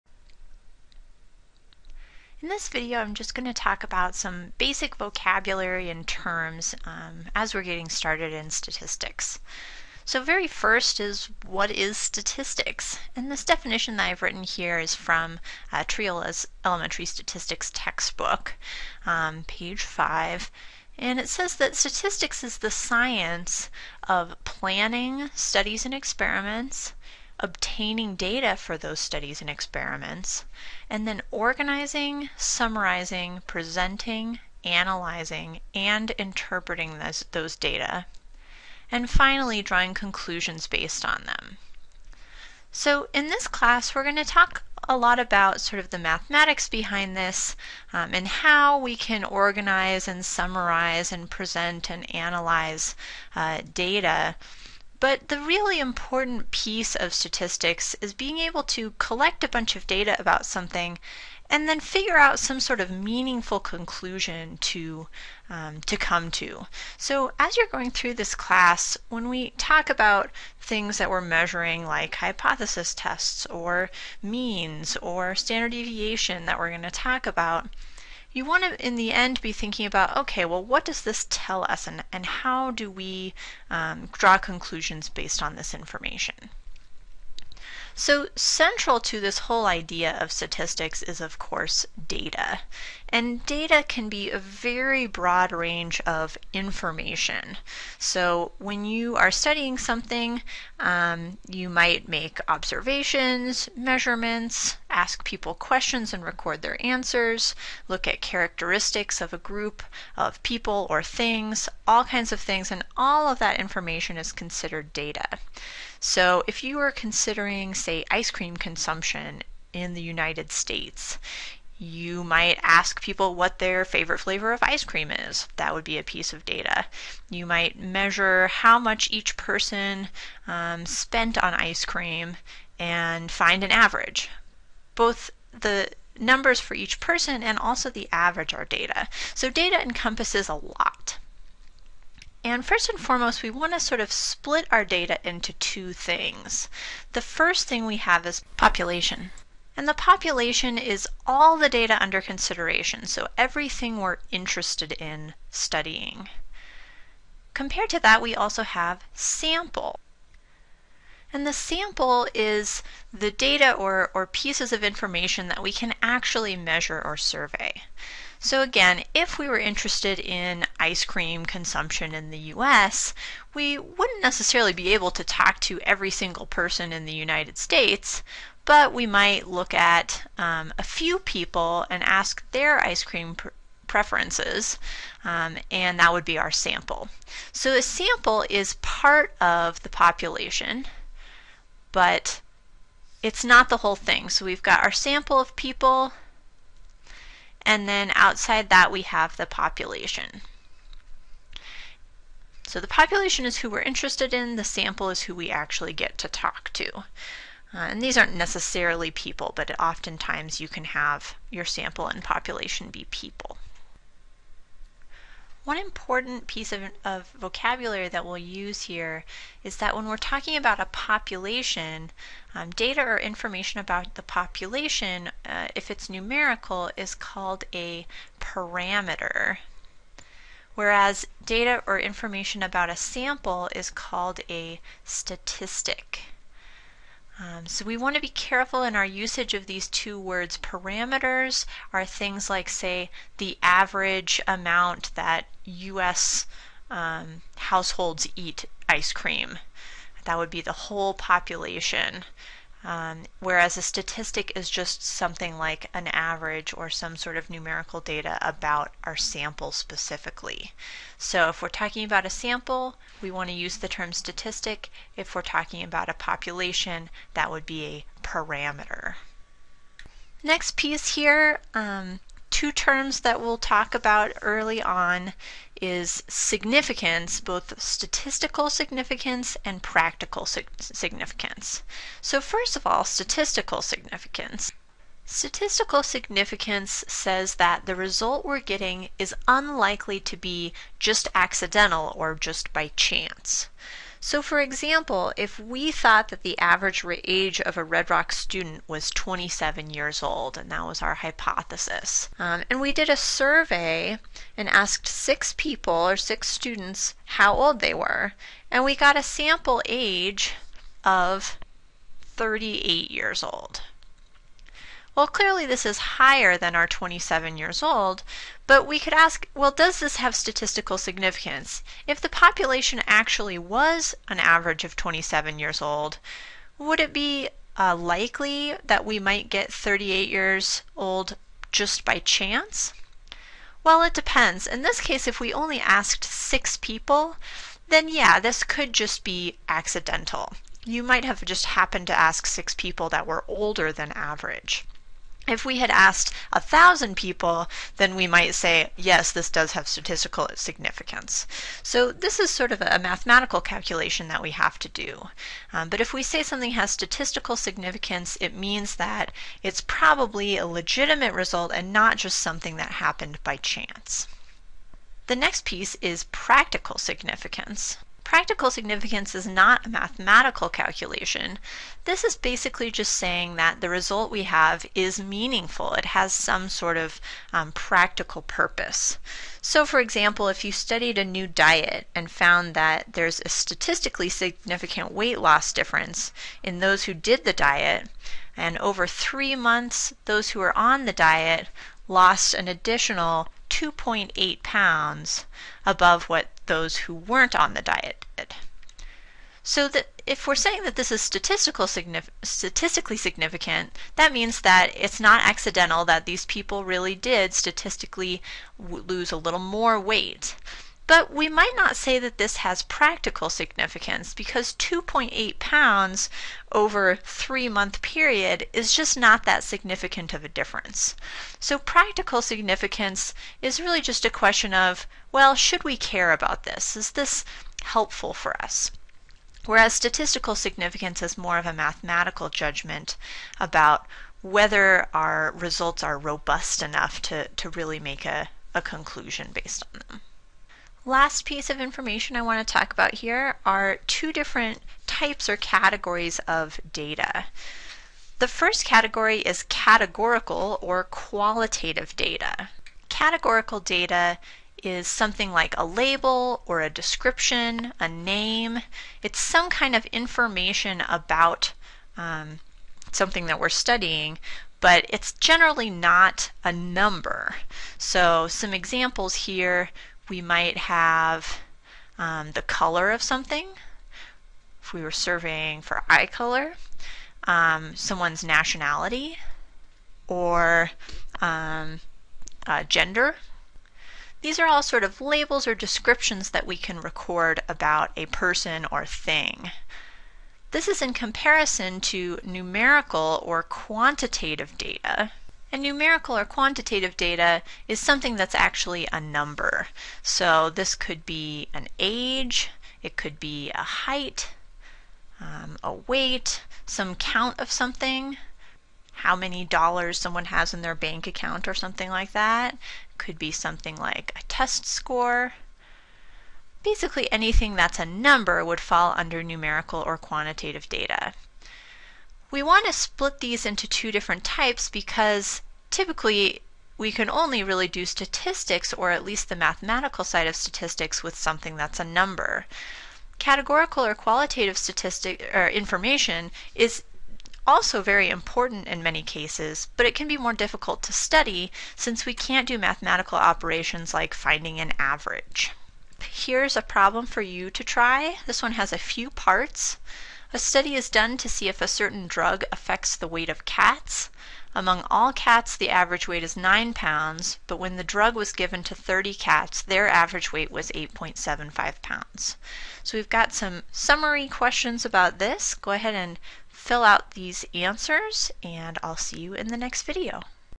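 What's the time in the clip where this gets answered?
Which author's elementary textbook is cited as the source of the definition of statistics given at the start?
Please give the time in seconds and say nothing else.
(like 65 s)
15 s.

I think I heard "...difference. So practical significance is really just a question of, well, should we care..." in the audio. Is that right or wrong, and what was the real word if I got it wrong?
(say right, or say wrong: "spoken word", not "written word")
right.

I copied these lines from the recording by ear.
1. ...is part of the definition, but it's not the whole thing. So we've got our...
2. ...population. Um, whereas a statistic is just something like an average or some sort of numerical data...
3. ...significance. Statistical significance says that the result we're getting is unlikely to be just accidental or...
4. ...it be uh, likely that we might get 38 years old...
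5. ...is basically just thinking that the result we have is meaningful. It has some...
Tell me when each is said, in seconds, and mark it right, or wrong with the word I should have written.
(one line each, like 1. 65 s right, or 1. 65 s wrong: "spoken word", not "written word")
1. 188 s wrong: "population", not "definition"
2. 251 s right
3. 283 s right
4. 327 s right
5. 372 s wrong: "saying", not "thinking".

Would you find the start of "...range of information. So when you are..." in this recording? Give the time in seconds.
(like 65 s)
95 s.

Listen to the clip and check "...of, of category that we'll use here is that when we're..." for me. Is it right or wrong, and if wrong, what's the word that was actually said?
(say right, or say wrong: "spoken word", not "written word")
wrong: "vocabulary", not "category".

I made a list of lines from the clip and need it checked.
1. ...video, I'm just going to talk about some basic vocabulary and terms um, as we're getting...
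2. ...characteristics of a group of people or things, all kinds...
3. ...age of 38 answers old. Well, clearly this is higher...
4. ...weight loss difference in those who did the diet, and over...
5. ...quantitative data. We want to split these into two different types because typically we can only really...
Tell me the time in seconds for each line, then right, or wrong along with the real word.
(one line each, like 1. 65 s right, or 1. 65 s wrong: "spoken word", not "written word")
1. 2 s right
2. 108 s right
3. 309 s wrong: "years", not "answers"
4. 385 s right
5. 520 s right.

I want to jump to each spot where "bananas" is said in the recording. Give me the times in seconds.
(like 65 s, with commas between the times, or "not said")
not said.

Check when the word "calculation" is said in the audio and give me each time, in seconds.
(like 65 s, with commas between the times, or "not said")
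353 s, 370 s.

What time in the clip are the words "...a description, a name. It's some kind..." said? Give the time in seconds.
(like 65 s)
456 s.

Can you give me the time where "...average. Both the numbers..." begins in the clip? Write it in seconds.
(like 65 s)
133 s.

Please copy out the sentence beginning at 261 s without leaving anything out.
So if we're talking about a sample, we want to use the term statistic.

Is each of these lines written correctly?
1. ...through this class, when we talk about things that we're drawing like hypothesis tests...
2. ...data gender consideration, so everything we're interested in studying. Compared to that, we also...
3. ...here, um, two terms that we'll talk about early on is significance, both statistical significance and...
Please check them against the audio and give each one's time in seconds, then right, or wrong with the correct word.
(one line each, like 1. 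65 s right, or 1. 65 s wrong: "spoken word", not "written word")
1. 67 s wrong: "measuring", not "drawing"
2. 151 s wrong: "under", not "gender"
3. 271 s right.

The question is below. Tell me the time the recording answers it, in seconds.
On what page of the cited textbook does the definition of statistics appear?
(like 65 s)
19 s.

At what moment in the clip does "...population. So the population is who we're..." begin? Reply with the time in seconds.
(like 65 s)
199 s.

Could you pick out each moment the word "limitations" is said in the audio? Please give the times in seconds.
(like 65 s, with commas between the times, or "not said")
not said.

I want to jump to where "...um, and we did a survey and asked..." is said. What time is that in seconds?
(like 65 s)
302 s.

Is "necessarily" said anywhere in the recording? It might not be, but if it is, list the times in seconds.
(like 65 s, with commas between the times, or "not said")
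174 s, 208 s.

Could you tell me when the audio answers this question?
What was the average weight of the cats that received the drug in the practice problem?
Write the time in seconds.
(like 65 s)
560 s.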